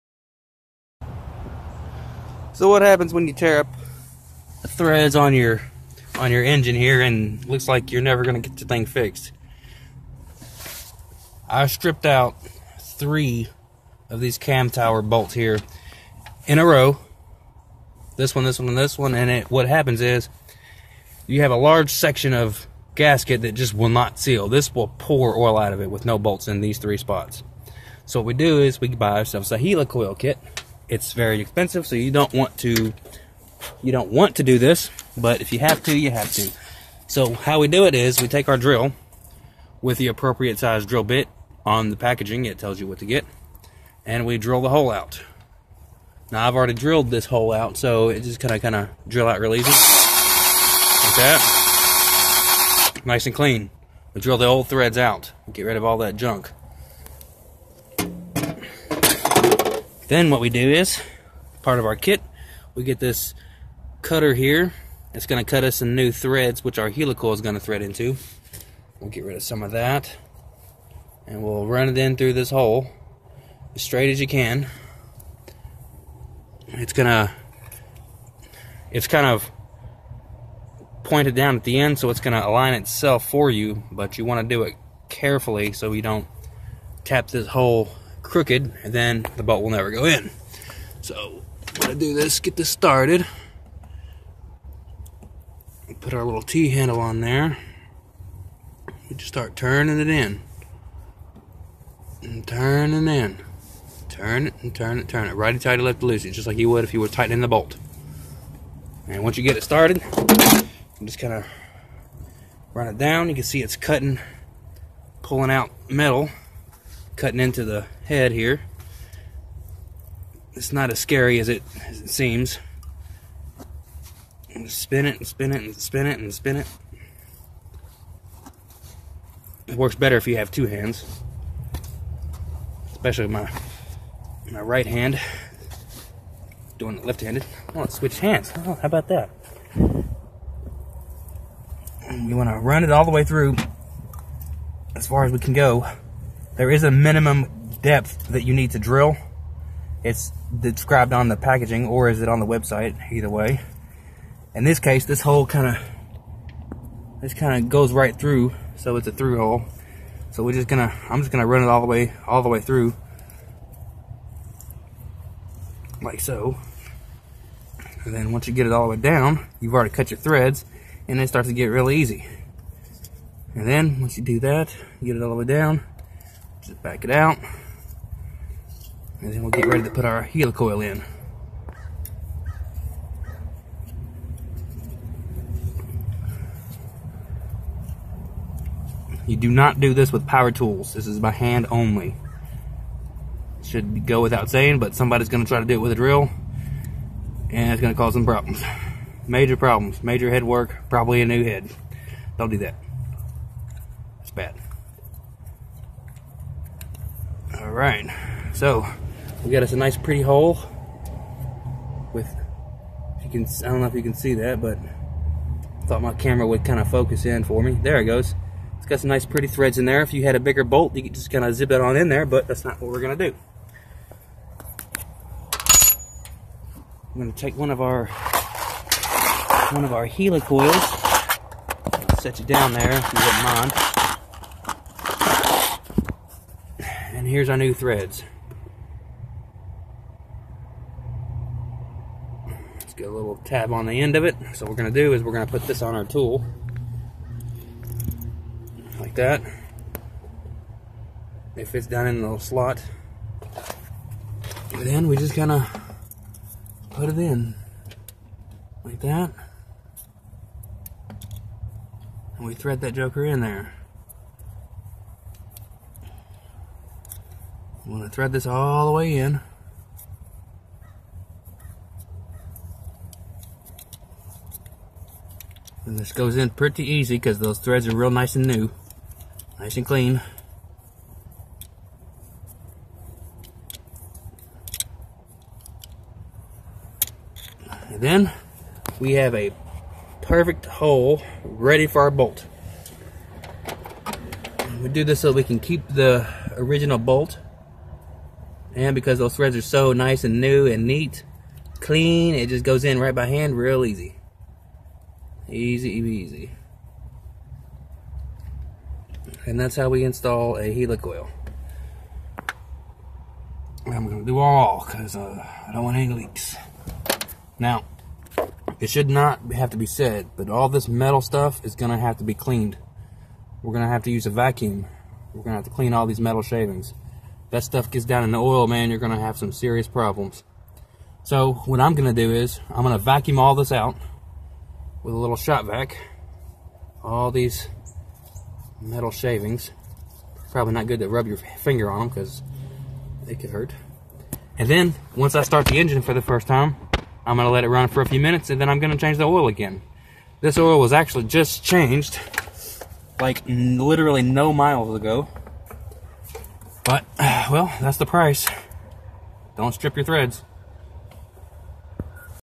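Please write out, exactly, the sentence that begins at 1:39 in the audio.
We just start turning it in.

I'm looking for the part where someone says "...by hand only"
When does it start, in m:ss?
3:11.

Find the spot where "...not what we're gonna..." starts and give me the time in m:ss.
3:42.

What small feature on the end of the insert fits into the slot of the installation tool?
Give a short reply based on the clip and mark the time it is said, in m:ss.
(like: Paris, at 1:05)
tab, at 4:03.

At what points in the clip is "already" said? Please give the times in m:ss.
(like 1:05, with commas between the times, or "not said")
0:46, 2:49.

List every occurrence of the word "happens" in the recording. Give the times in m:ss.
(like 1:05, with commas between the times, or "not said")
0:02, 0:19.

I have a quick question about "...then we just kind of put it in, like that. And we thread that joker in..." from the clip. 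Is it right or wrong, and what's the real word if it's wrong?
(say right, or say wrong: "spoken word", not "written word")
right.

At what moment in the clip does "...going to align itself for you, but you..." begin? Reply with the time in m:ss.
1:22.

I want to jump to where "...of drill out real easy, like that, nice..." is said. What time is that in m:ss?
0:48.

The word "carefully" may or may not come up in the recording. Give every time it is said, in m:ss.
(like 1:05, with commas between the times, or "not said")
1:25.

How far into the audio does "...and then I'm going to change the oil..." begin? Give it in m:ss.
5:48.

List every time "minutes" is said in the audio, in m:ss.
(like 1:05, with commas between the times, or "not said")
5:48.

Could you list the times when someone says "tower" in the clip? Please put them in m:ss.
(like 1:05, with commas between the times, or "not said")
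0:14.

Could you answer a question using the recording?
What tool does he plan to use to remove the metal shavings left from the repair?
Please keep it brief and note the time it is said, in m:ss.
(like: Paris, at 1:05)
shop vac, at 5:35.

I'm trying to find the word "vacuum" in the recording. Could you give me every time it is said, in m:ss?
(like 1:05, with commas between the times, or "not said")
5:24, 5:33.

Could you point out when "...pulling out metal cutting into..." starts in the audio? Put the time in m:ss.
1:55.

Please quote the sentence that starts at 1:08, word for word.
We'll get rid of some of that.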